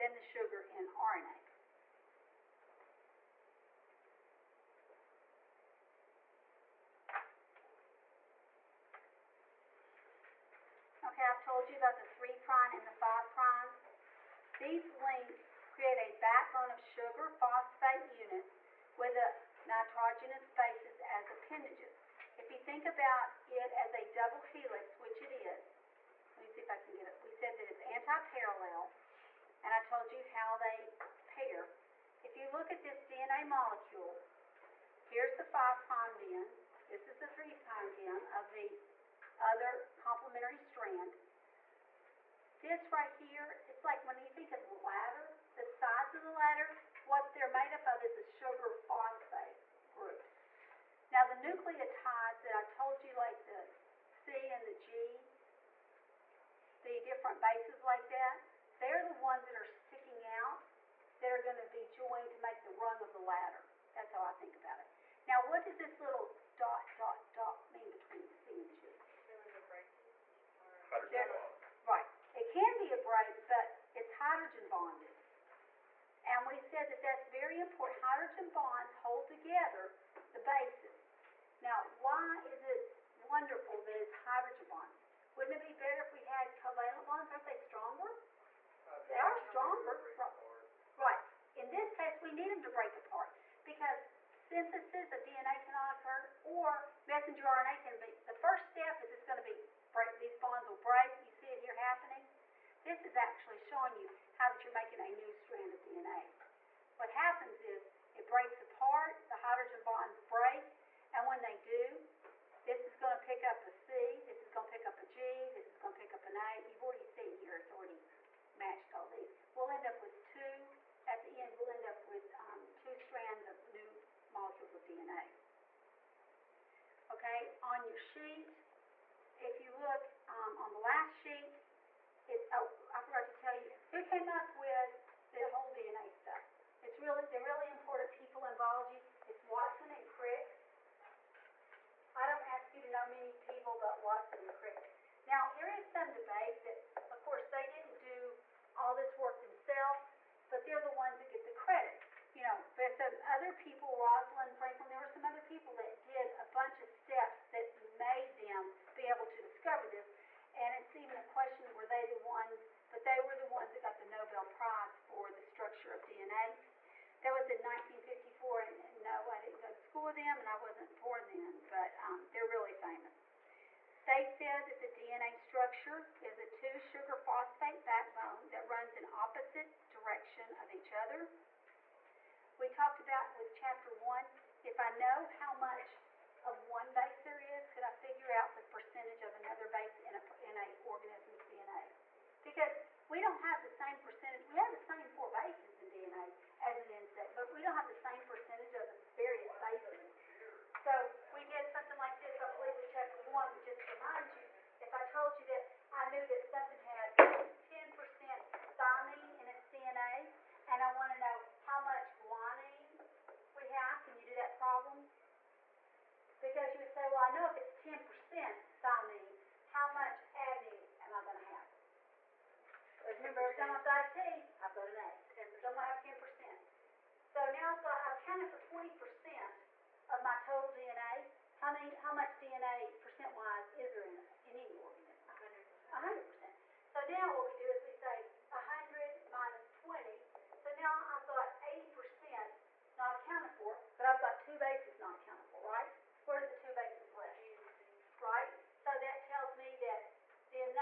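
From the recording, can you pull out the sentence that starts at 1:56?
You've already seen here, it's already matched all these.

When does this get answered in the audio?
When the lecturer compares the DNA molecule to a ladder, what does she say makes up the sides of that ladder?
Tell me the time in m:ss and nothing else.
0:48.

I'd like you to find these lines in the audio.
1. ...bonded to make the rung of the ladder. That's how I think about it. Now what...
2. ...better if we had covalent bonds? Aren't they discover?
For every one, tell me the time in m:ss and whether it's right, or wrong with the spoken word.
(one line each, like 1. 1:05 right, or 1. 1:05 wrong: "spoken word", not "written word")
1. 1:01 wrong: "joined", not "bonded"
2. 1:25 wrong: "stronger", not "discover".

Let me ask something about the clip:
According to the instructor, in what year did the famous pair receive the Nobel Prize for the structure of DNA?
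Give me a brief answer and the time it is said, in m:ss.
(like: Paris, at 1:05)
1954, at 2:47.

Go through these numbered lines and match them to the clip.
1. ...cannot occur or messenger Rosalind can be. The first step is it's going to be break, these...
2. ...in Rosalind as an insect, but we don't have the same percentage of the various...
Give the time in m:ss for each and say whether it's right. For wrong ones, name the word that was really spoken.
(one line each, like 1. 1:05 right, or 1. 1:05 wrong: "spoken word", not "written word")
1. 1:35 wrong: "RNA", not "Rosalind"
2. 3:15 wrong: "DNA", not "Rosalind".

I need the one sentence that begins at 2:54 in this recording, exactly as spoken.
They said that the DNA structure is a two sugar phosphate backbone that runs in opposite direction of each other.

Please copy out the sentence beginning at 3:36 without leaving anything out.
Because you would say, well, I know if it's 10% thymine, how much adenine am I going to have?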